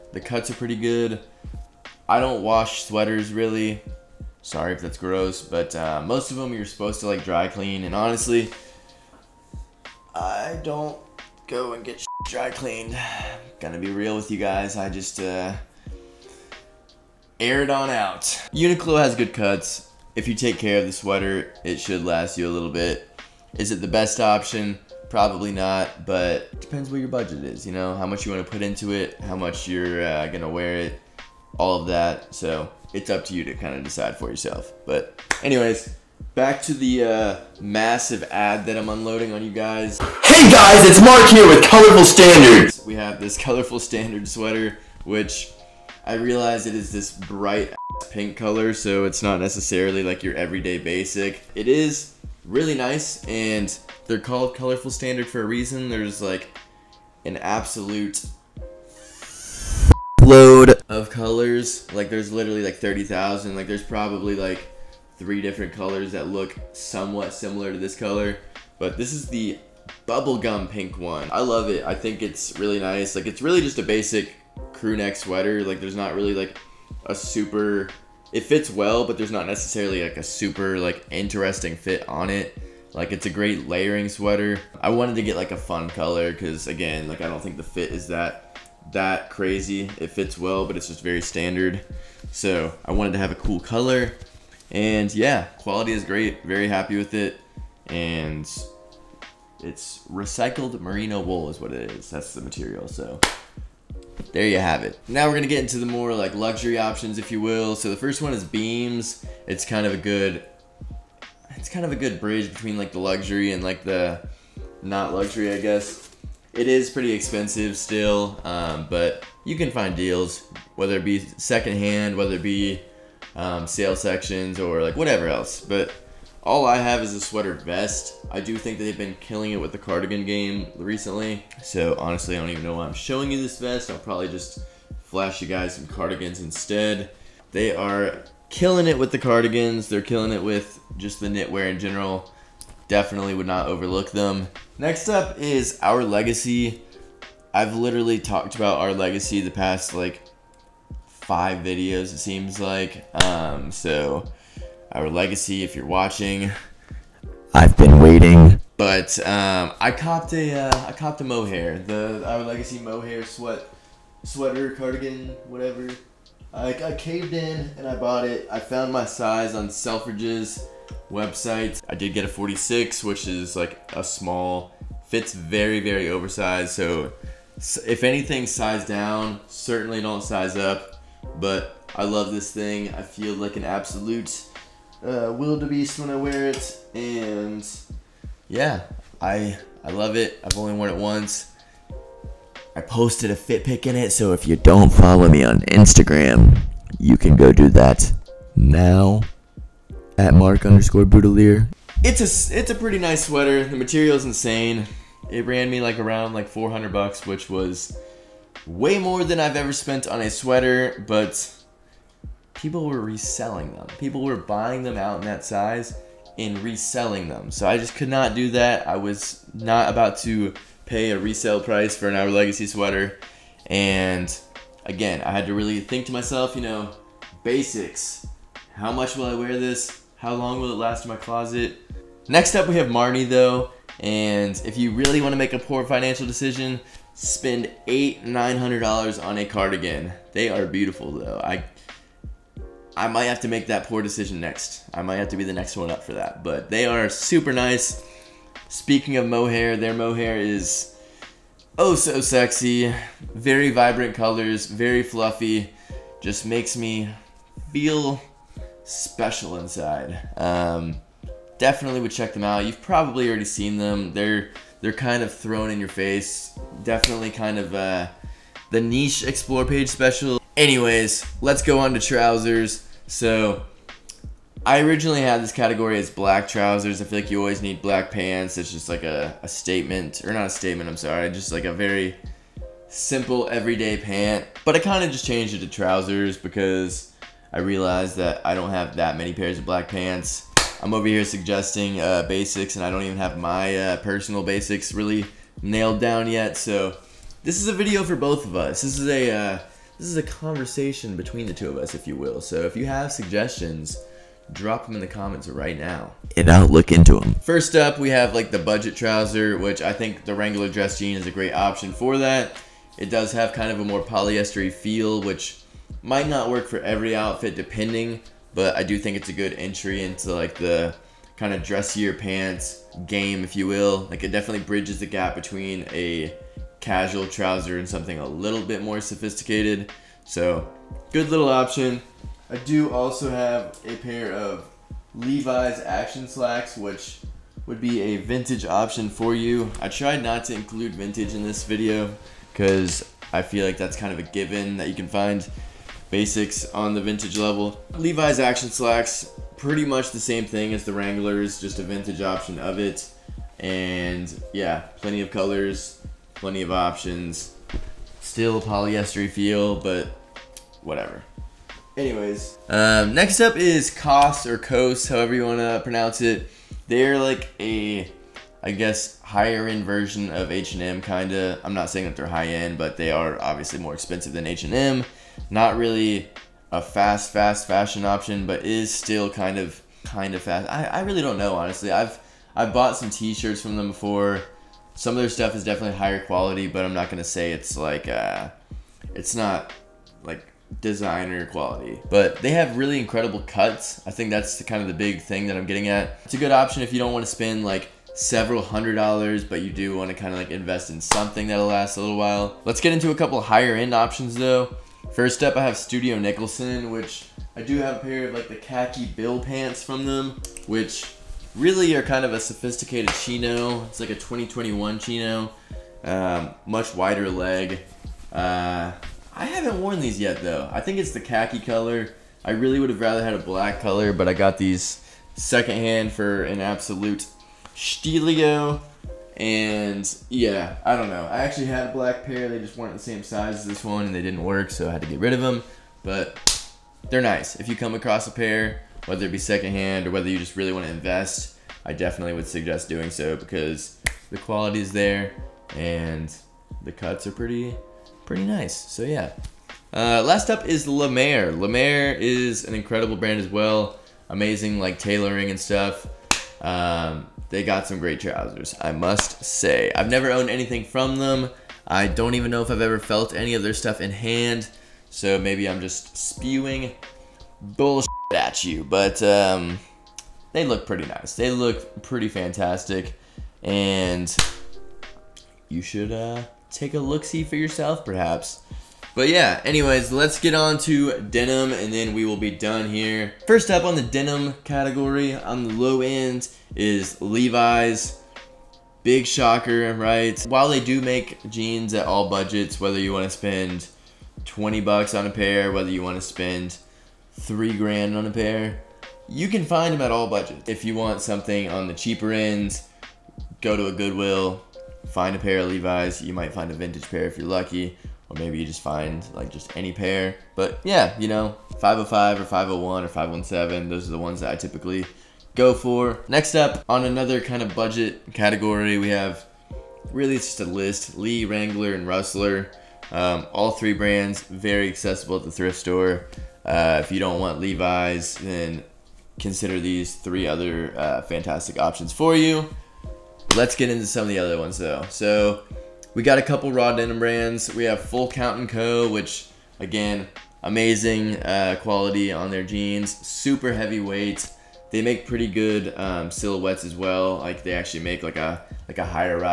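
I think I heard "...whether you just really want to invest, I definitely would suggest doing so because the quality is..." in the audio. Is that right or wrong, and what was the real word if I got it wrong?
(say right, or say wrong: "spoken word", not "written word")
right.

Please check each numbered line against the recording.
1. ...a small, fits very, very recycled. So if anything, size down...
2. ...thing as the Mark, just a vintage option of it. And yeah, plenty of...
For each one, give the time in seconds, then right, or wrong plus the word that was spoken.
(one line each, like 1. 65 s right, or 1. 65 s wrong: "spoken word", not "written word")
1. 173 s wrong: "oversized", not "recycled"
2. 350 s wrong: "Wranglers", not "Mark".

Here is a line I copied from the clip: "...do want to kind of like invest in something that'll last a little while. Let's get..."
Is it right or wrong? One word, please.
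right.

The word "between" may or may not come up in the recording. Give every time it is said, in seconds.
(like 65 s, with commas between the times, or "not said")
112 s, 301 s, 325 s.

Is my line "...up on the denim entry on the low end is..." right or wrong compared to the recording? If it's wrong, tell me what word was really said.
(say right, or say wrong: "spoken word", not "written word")
wrong: "category", not "entry".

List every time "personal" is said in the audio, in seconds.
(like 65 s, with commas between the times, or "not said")
293 s.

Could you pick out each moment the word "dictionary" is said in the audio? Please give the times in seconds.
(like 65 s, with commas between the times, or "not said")
not said.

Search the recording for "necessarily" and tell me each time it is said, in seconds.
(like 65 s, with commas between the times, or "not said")
49 s, 79 s.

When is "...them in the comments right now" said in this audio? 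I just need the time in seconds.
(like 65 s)
304 s.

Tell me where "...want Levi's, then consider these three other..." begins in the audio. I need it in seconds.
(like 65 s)
527 s.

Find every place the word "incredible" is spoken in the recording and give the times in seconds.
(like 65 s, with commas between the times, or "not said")
392 s, 452 s.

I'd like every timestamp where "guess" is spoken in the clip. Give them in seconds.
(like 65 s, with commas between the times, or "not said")
115 s, 368 s.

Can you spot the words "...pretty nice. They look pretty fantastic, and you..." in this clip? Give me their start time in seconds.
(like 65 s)
470 s.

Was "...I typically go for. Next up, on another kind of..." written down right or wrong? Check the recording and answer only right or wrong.
right.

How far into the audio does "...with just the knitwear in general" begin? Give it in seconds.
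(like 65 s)
140 s.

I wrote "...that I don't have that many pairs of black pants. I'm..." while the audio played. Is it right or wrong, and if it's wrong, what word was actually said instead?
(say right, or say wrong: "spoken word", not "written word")
right.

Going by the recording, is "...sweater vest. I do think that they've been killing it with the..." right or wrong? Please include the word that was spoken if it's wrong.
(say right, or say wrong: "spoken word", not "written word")
right.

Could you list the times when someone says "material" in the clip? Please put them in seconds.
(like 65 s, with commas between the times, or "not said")
102 s, 203 s.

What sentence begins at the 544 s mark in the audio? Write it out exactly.
They make pretty good um, silhouettes as well.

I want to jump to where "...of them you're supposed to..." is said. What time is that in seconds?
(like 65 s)
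6 s.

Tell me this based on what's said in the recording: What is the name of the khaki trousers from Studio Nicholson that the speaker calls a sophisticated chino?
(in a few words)
bill pants.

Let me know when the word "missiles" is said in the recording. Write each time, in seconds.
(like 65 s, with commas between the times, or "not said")
not said.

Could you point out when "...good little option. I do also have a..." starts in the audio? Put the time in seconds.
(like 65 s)
331 s.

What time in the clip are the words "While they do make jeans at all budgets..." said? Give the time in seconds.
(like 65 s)
490 s.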